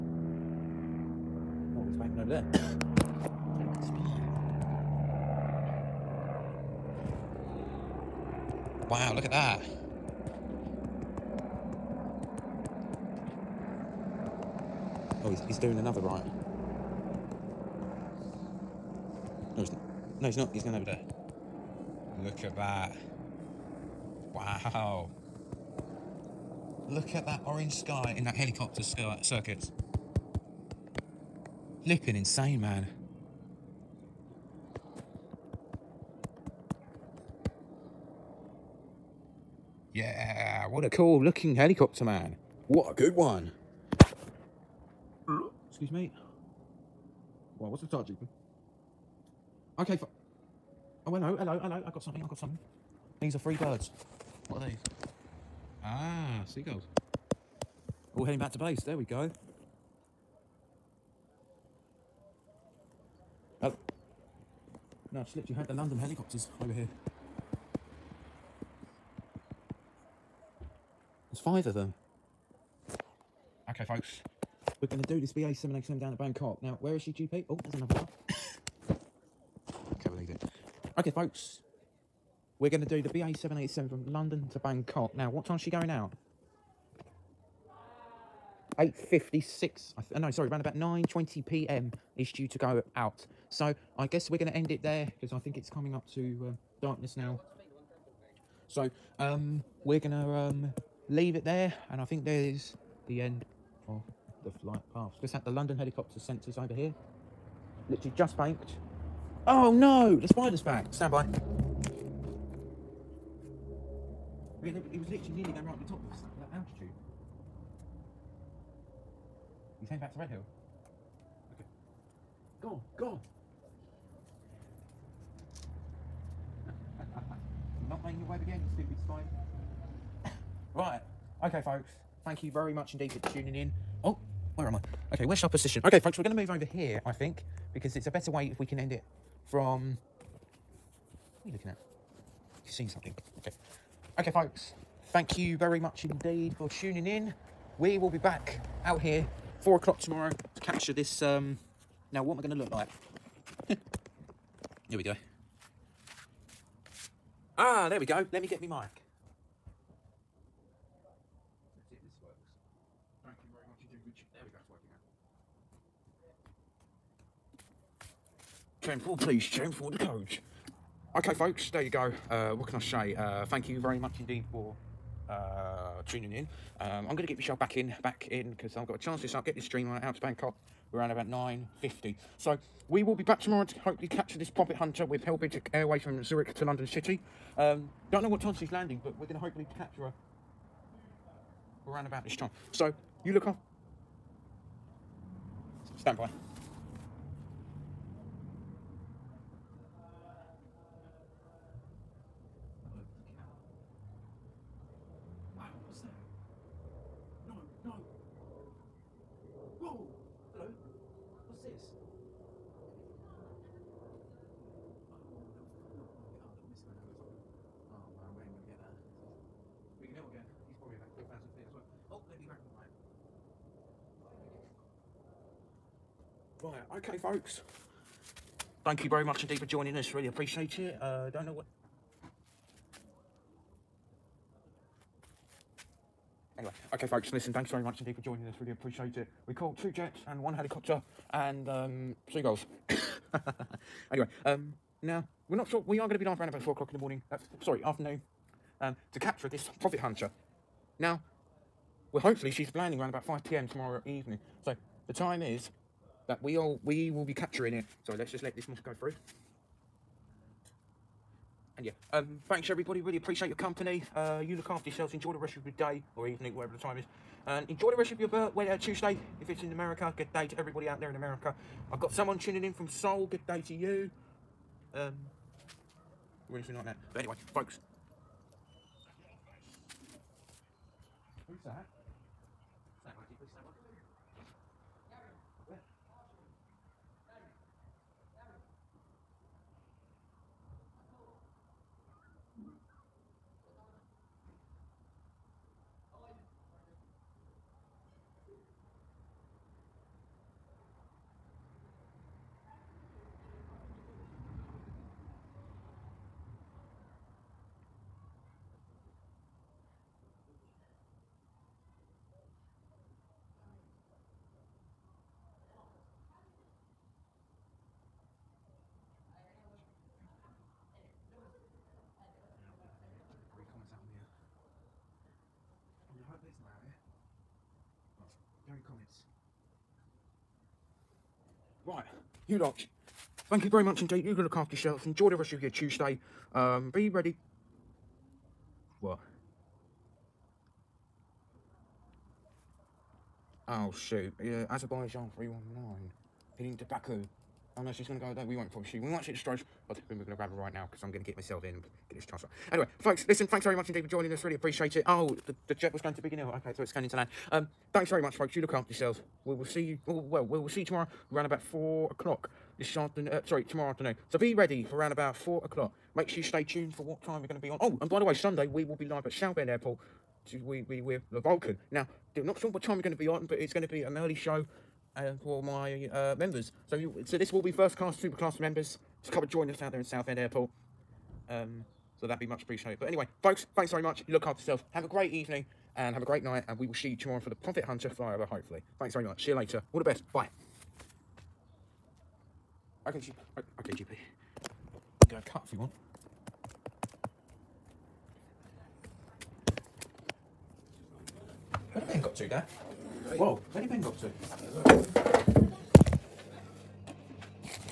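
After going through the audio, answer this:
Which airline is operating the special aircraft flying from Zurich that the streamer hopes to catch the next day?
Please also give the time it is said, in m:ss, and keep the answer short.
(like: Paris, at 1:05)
Helvetic Airways, at 3:05.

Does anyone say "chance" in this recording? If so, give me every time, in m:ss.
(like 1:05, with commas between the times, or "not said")
2:58.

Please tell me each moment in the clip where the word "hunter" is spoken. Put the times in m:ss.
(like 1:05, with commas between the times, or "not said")
3:04, 4:09, 6:27.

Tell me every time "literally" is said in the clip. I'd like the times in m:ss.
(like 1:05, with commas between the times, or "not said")
1:47, 1:55.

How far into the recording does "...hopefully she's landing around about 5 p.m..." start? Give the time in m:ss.
4:12.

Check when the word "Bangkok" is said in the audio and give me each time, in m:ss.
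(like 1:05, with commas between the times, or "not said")
1:16, 1:24, 3:00.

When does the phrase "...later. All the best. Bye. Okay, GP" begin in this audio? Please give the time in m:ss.
6:29.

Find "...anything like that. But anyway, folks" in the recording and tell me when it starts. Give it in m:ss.
4:36.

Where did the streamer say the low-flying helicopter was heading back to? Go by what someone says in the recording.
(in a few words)
Redhill.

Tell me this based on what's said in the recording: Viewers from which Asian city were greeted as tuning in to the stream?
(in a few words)
Seoul.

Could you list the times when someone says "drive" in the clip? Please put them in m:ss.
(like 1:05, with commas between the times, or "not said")
not said.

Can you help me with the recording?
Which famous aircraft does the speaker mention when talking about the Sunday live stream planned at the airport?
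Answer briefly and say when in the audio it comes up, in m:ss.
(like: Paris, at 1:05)
The Vulcan, at 6:11.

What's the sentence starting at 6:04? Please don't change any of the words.
So be ready for around about 4 o'clock.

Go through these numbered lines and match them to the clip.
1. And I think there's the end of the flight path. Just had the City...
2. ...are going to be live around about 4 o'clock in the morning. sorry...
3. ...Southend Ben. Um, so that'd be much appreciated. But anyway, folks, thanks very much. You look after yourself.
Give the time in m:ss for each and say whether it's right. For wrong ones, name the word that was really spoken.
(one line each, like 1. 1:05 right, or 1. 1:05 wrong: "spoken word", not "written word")
1. 1:41 wrong: "London", not "City"
2. 4:05 right
3. 6:20 wrong: "Airport", not "Ben".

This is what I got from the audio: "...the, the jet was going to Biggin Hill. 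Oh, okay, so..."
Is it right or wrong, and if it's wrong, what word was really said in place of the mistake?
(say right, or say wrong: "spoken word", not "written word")
right.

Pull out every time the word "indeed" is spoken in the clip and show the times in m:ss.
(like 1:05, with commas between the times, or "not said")
2:12, 2:26, 2:54, 3:49, 3:57, 5:34, 5:53.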